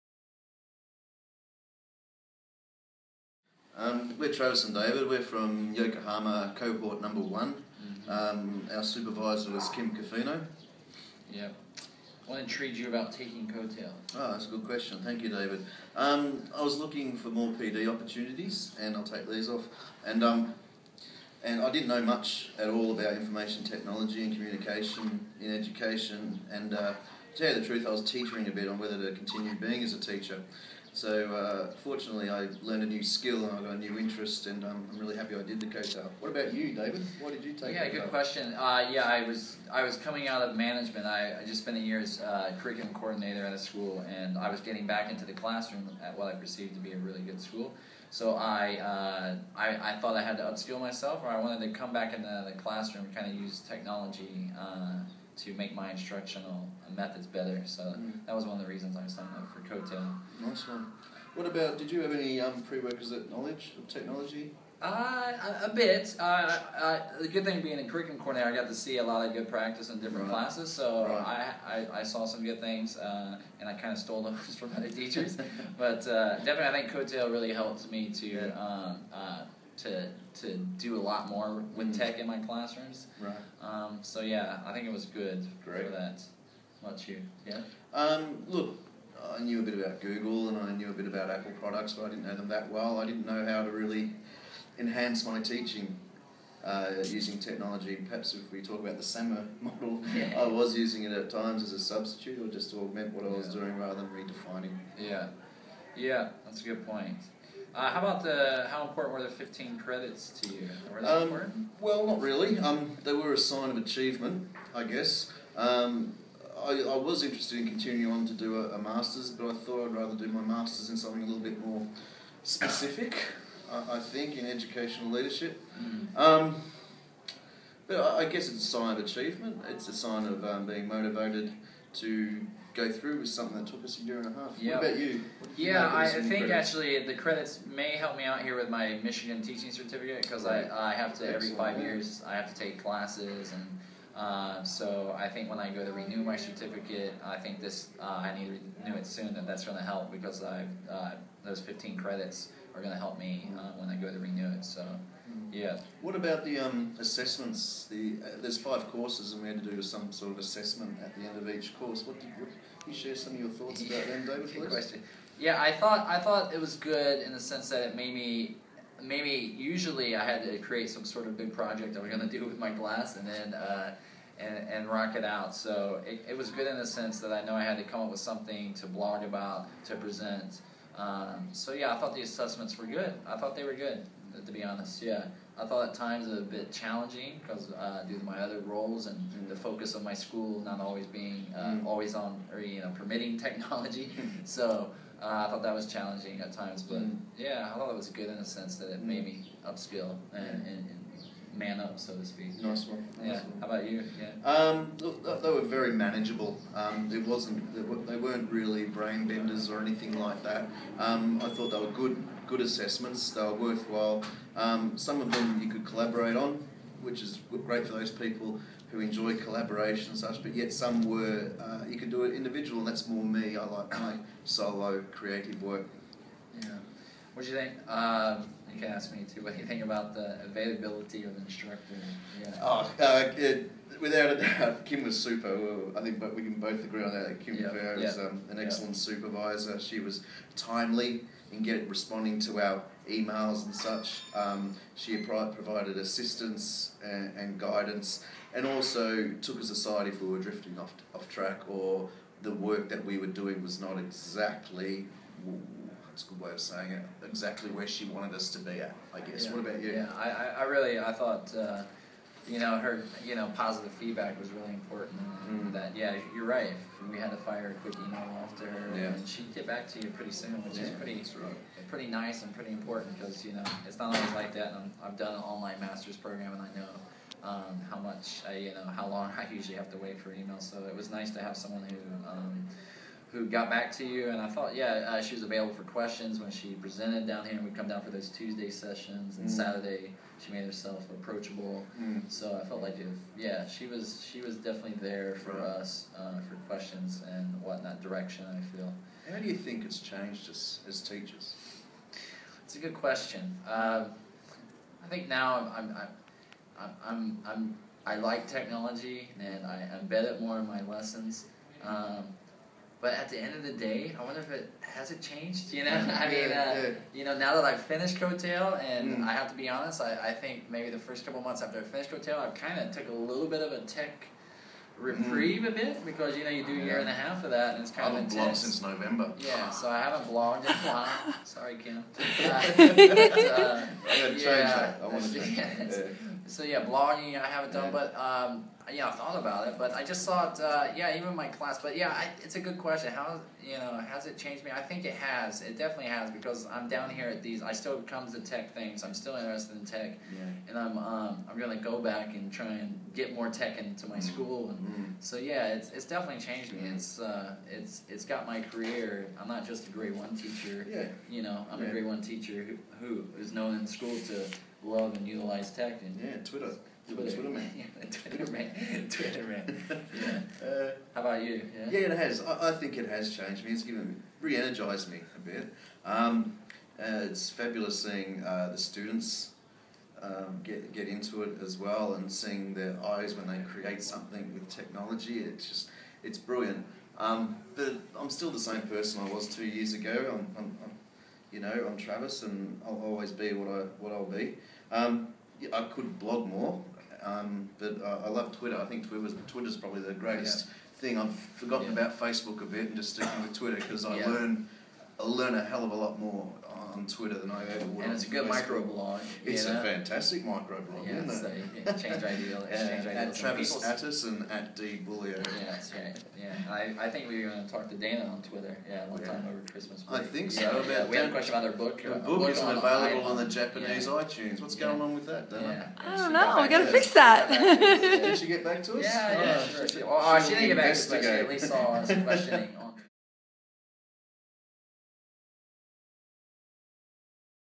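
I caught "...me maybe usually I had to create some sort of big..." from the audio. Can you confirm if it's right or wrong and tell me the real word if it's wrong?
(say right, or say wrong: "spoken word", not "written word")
right.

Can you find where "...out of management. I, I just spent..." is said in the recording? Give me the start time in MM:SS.
00:40.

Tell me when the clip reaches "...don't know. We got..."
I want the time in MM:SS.
07:06.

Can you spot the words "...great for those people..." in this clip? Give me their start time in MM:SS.
03:37.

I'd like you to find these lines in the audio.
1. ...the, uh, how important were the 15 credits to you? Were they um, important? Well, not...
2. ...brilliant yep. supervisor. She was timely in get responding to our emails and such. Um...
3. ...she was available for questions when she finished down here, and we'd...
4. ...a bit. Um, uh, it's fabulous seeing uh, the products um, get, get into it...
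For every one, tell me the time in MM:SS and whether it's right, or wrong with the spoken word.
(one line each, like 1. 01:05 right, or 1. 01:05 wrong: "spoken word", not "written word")
1. 01:48 right
2. 03:58 wrong: "excellent", not "brilliant"
3. 04:45 wrong: "presented", not "finished"
4. 06:15 wrong: "students", not "products".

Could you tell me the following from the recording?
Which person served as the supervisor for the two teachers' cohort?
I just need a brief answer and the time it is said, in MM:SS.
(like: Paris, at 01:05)
Kim Cofino, at 00:09.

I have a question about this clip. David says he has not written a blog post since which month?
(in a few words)
November.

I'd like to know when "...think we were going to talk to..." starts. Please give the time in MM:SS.
06:57.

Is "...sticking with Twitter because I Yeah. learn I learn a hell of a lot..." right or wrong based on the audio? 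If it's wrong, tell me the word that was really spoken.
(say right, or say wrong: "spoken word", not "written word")
right.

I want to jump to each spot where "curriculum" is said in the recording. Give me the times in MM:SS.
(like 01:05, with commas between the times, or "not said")
00:42, 01:07.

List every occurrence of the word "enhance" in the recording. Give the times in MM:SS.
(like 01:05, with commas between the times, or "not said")
01:34.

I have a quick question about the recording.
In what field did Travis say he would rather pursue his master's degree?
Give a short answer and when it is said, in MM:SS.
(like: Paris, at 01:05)
educational leadership, at 02:04.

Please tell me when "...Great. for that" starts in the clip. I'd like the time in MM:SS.
01:25.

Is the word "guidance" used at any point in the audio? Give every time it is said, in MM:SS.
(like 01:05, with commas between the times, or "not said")
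04:07.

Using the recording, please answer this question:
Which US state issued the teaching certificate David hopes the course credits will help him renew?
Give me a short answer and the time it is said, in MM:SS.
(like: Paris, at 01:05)
Michigan, at 02:19.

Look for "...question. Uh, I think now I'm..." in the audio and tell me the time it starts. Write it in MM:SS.
05:02.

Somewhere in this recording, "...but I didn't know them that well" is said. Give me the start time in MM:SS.
01:31.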